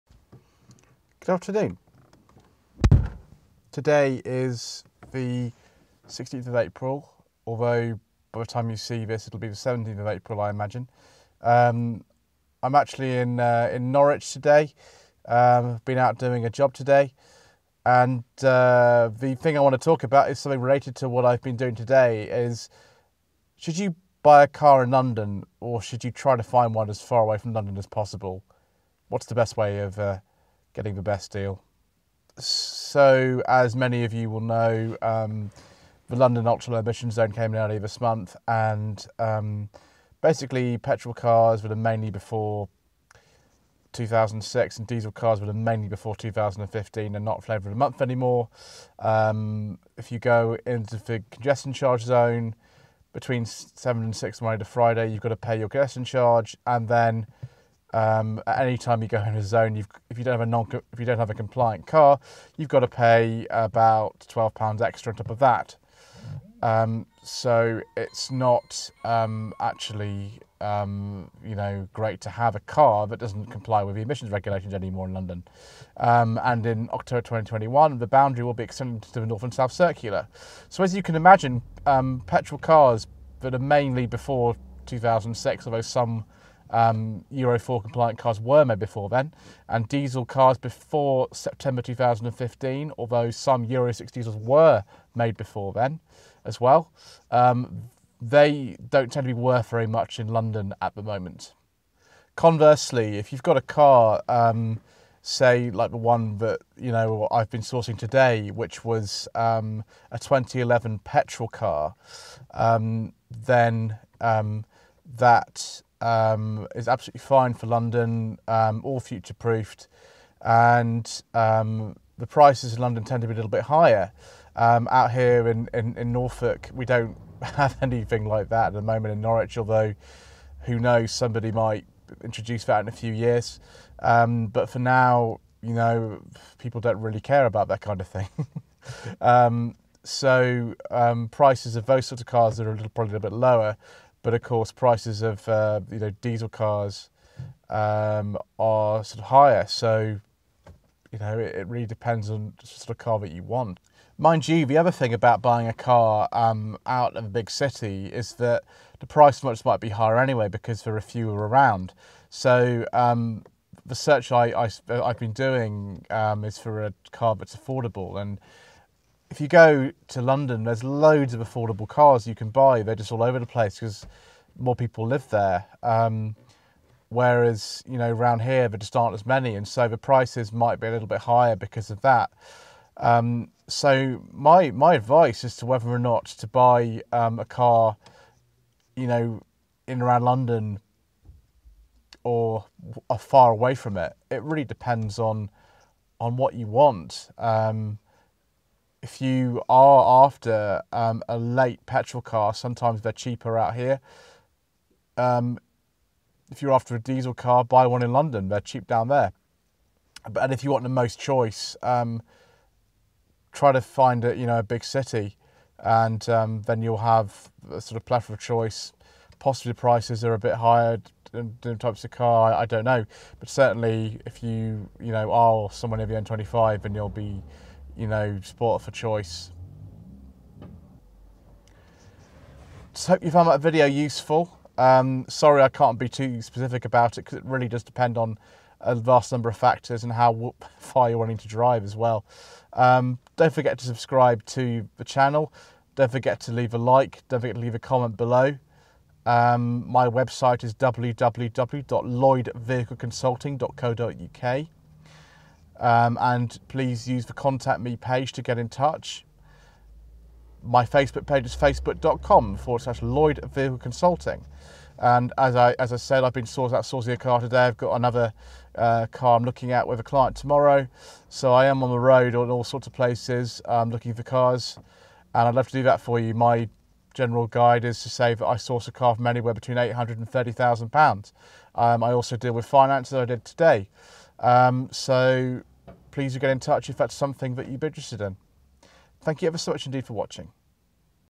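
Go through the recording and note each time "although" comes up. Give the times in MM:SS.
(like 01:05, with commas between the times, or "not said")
00:07, 01:25, 01:32, 02:09.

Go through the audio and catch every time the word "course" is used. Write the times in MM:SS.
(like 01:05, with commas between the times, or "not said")
02:24.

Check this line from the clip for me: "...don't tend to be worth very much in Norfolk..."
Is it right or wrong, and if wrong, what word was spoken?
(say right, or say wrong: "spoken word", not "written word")
wrong: "London", not "Norfolk".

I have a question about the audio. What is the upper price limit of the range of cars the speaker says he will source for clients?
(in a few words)
£30,000.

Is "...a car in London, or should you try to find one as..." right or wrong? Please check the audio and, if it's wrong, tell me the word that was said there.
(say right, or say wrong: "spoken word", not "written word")
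right.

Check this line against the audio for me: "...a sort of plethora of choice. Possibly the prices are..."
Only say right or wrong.
right.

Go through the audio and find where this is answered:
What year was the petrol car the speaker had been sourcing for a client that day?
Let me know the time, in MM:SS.
01:50.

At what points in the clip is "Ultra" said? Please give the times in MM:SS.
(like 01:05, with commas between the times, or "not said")
00:36.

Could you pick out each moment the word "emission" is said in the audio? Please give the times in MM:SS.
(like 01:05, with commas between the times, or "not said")
00:36, 01:14.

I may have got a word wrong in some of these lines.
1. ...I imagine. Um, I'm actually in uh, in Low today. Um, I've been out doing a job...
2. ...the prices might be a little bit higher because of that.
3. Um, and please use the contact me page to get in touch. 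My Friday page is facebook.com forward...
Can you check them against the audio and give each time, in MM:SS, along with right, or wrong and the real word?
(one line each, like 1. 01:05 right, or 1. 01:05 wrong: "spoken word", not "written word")
1. 00:10 wrong: "Norwich", not "Low"
2. 02:59 right
3. 04:15 wrong: "Facebook", not "Friday".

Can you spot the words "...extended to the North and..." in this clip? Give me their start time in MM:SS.
01:18.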